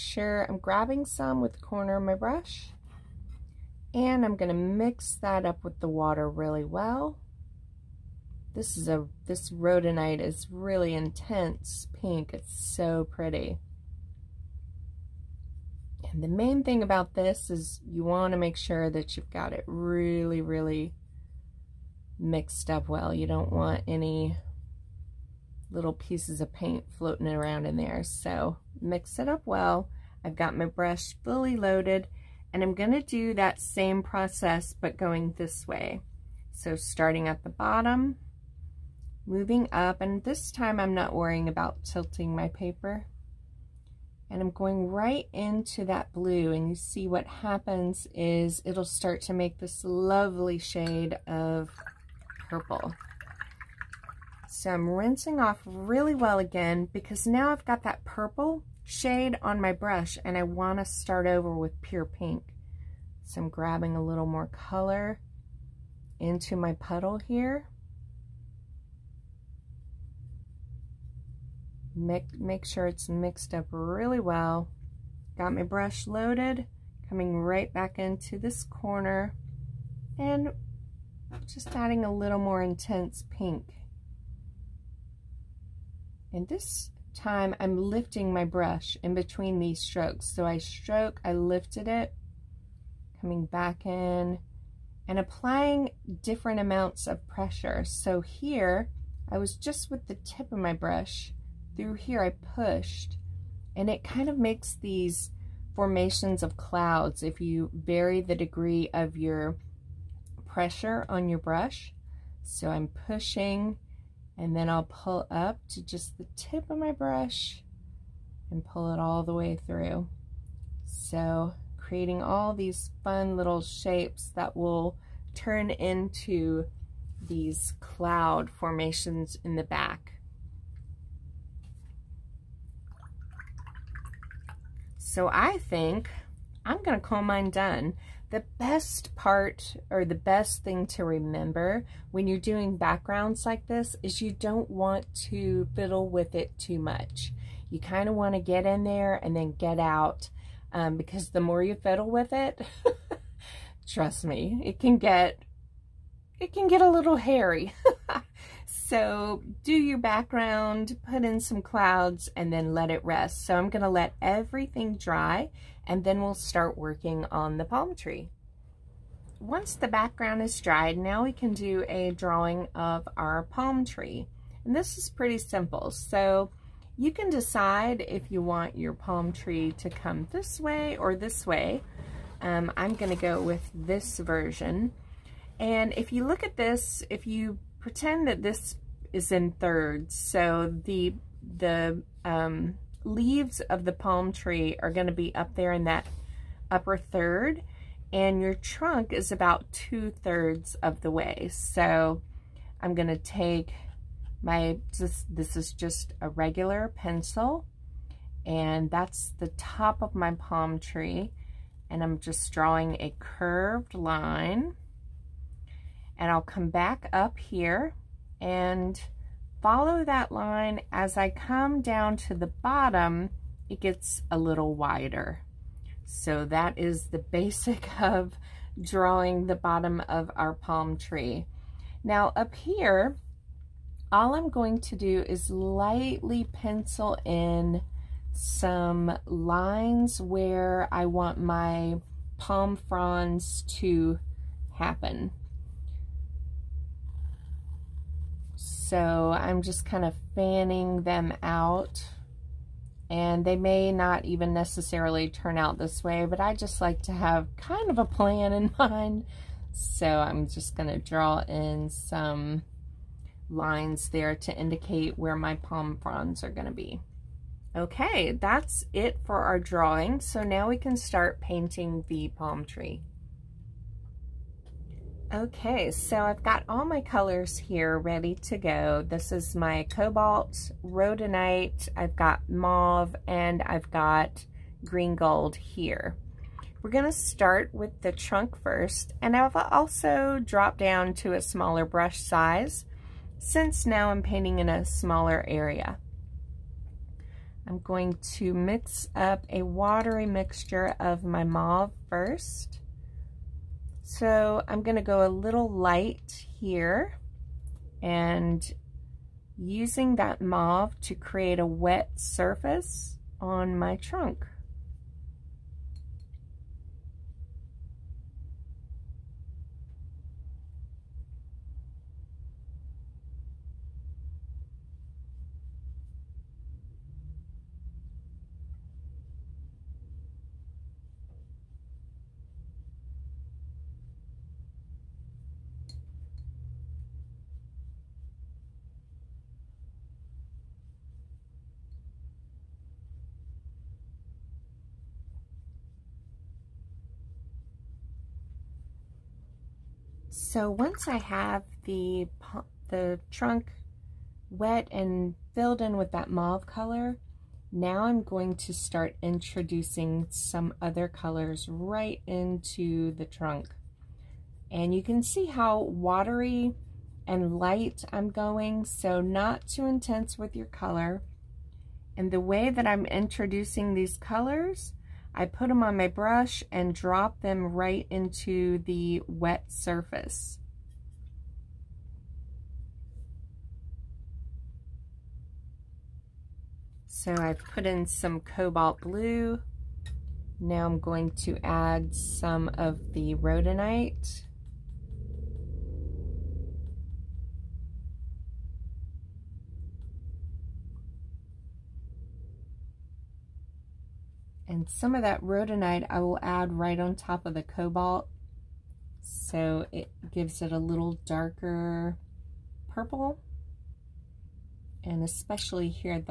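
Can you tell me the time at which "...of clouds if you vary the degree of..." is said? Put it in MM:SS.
01:46.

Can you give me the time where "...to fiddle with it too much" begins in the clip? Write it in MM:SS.
02:25.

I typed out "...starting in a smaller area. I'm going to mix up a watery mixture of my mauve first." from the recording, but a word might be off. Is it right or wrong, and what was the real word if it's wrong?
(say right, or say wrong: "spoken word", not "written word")
wrong: "painting", not "starting".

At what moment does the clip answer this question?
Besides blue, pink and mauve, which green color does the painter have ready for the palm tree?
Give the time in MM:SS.
04:44.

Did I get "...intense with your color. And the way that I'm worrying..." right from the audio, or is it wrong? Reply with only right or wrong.
wrong.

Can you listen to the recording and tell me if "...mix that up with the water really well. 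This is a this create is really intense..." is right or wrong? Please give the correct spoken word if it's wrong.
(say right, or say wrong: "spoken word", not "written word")
wrong: "rhodonite", not "create".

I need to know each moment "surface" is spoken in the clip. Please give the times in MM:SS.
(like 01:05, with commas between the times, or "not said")
05:12, 06:19.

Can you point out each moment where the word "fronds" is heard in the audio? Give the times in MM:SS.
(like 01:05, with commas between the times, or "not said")
04:02, 04:26.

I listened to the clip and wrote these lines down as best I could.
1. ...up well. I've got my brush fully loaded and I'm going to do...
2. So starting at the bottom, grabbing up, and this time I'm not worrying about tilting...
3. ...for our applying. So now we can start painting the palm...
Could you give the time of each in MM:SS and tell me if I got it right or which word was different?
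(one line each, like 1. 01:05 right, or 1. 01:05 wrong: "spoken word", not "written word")
1. 00:29 right
2. 00:36 wrong: "moving", not "grabbing"
3. 04:29 wrong: "drawing", not "applying".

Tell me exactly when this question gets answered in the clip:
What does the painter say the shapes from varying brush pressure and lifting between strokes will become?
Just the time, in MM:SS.
02:07.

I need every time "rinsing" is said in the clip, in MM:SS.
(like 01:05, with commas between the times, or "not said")
00:54.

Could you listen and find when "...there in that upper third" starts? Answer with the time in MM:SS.
03:15.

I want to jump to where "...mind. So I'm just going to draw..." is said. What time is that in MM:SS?
04:18.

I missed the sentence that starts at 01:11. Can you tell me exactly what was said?
Make, make sure it's mixed up really well.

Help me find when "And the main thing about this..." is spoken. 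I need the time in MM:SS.
00:16.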